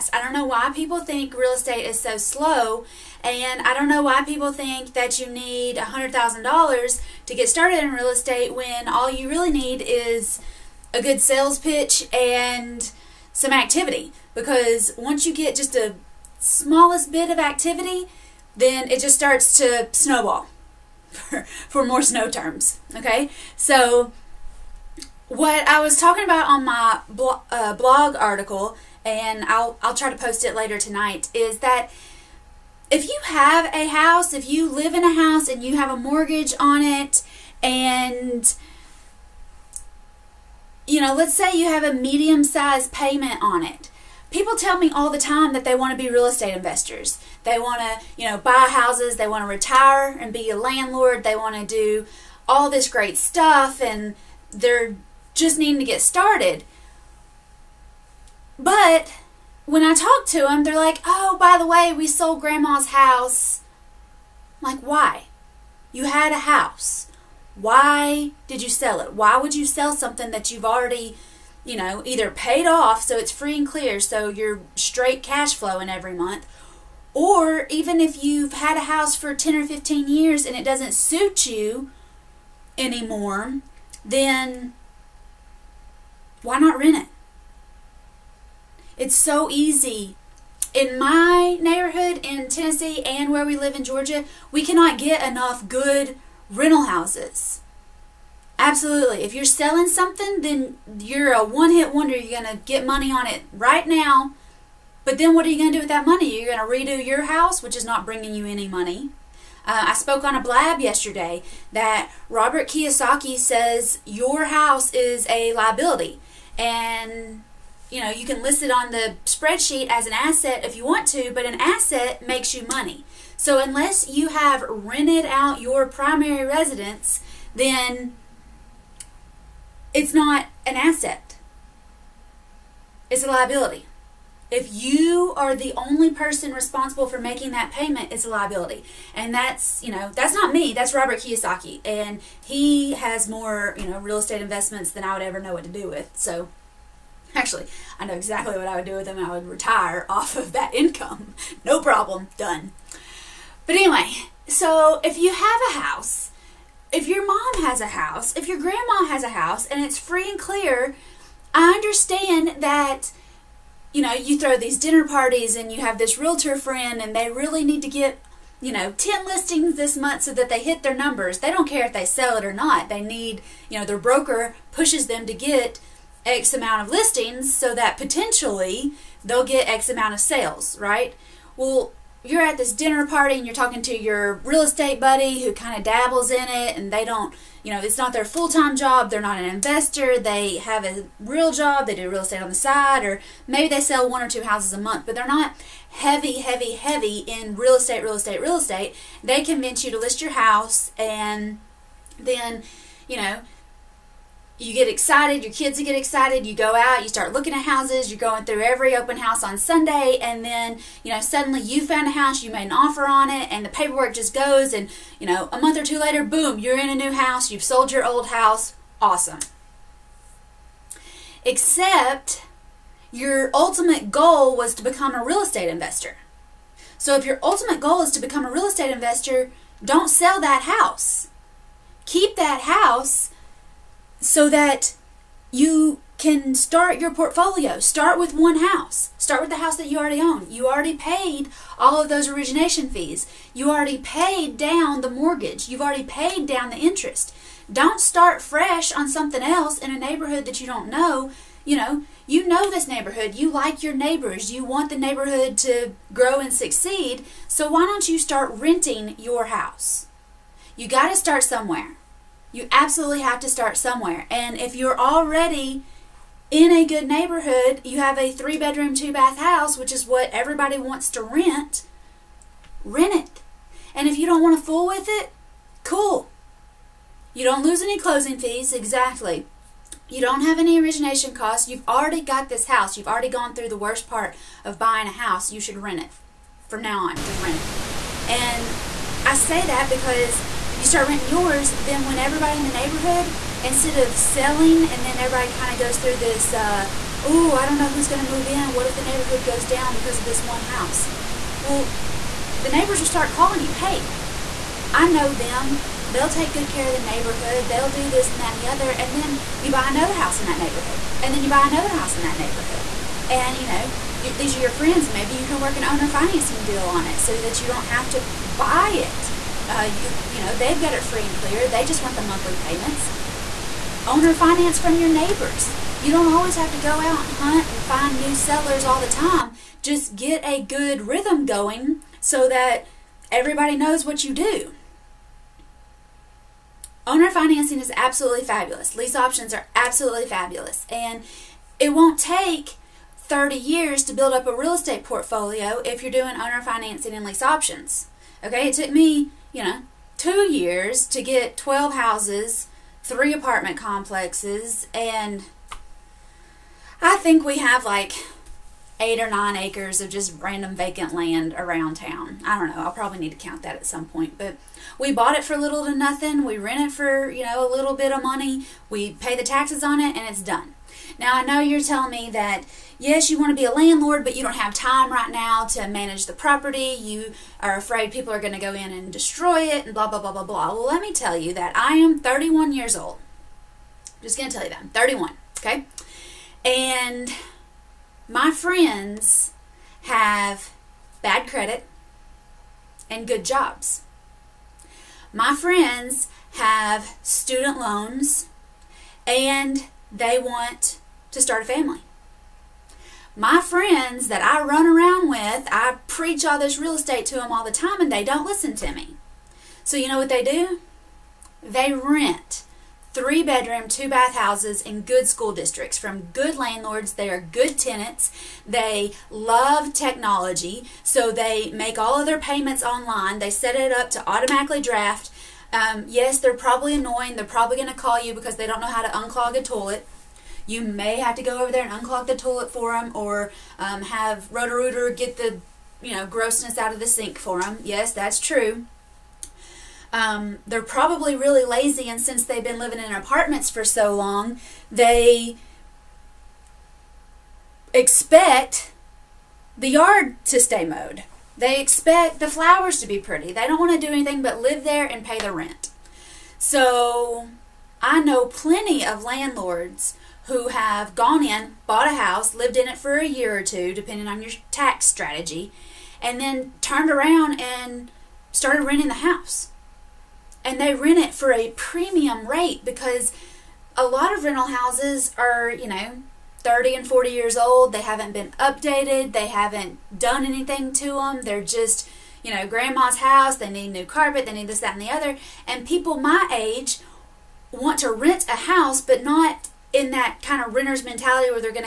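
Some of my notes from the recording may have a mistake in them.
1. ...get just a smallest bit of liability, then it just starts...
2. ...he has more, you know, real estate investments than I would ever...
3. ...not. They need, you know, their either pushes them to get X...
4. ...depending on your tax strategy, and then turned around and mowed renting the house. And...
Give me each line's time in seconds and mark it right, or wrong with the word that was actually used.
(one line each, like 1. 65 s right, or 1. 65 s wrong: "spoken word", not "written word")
1. 15 s wrong: "activity", not "liability"
2. 142 s right
3. 172 s wrong: "broker", not "either"
4. 463 s wrong: "started", not "mowed".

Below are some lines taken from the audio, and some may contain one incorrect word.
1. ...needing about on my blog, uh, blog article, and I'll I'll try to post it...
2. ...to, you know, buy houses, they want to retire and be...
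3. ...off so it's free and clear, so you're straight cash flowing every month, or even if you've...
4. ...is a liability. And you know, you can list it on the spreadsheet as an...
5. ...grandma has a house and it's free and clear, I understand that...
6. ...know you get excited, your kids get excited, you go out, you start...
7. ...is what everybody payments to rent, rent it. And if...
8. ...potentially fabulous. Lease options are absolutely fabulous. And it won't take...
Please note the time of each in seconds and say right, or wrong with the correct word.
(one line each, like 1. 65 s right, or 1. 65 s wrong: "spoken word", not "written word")
1. 25 s wrong: "talking", not "needing"
2. 47 s right
3. 72 s right
4. 114 s right
5. 158 s right
6. 203 s right
7. 269 s wrong: "wants", not "payments"
8. 337 s wrong: "absolutely", not "potentially".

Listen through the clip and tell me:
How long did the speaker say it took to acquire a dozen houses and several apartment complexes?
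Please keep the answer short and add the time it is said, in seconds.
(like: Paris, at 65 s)
two years, at 350 s.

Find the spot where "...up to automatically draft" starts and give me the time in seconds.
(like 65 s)
423 s.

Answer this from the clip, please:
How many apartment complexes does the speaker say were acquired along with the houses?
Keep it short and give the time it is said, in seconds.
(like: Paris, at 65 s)
3, at 353 s.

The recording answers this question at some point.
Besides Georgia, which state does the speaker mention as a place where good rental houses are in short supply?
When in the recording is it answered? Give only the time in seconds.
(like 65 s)
92 s.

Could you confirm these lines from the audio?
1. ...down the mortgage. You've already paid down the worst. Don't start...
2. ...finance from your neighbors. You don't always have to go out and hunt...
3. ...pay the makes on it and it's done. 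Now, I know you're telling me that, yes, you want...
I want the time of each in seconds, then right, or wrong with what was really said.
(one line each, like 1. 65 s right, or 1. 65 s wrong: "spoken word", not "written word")
1. 244 s wrong: "interest", not "worst"
2. 324 s right
3. 369 s wrong: "taxes", not "makes".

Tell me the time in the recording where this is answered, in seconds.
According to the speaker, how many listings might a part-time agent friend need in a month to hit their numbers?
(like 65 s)
168 s.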